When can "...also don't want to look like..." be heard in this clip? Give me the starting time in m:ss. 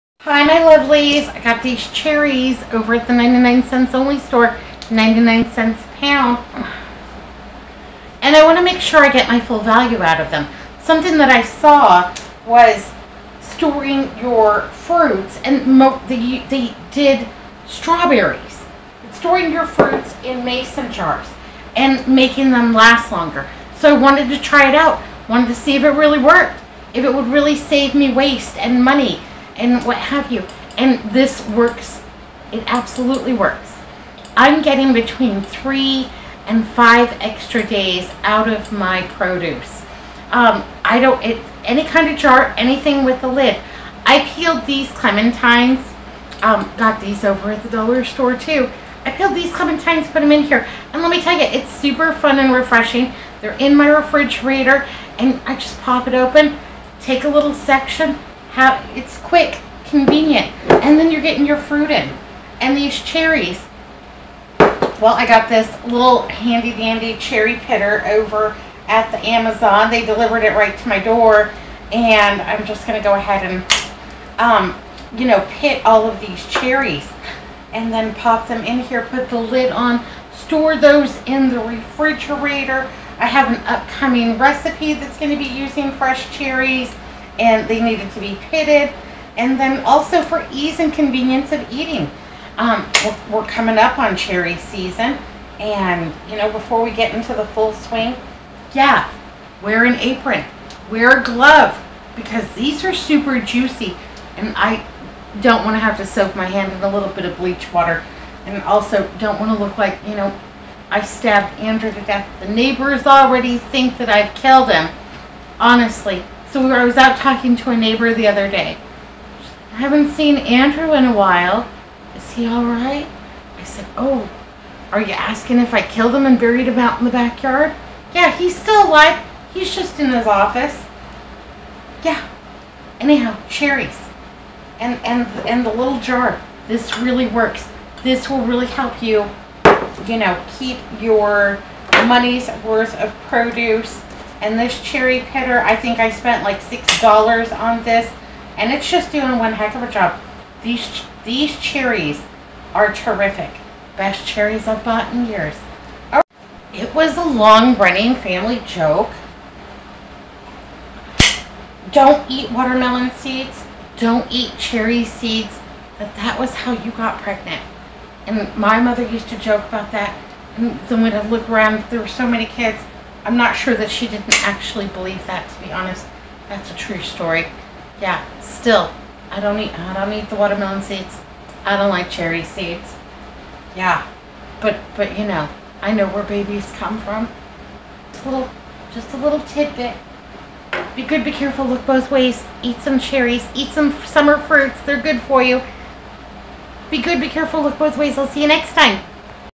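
1:48.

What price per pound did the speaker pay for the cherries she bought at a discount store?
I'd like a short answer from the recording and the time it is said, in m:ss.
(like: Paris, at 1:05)
99 cents, at 0:04.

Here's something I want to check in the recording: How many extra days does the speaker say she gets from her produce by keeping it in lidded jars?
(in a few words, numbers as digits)
3 to 5.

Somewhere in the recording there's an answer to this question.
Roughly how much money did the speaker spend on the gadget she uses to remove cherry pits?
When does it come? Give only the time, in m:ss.
2:26.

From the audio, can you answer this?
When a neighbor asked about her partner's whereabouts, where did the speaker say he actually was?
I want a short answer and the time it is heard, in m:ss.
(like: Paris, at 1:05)
In his office, at 2:10.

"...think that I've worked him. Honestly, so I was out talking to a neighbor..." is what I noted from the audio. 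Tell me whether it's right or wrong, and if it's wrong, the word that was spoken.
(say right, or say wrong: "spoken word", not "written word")
wrong: "killed", not "worked".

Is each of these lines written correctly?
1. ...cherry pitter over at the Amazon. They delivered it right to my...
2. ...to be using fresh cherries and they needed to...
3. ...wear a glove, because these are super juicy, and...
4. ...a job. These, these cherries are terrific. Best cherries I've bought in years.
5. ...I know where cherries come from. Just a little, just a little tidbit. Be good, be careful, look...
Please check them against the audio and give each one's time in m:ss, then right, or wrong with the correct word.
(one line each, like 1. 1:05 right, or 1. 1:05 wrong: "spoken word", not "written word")
1. 1:07 right
2. 1:25 right
3. 1:40 right
4. 2:29 right
5. 3:05 wrong: "babies", not "cherries".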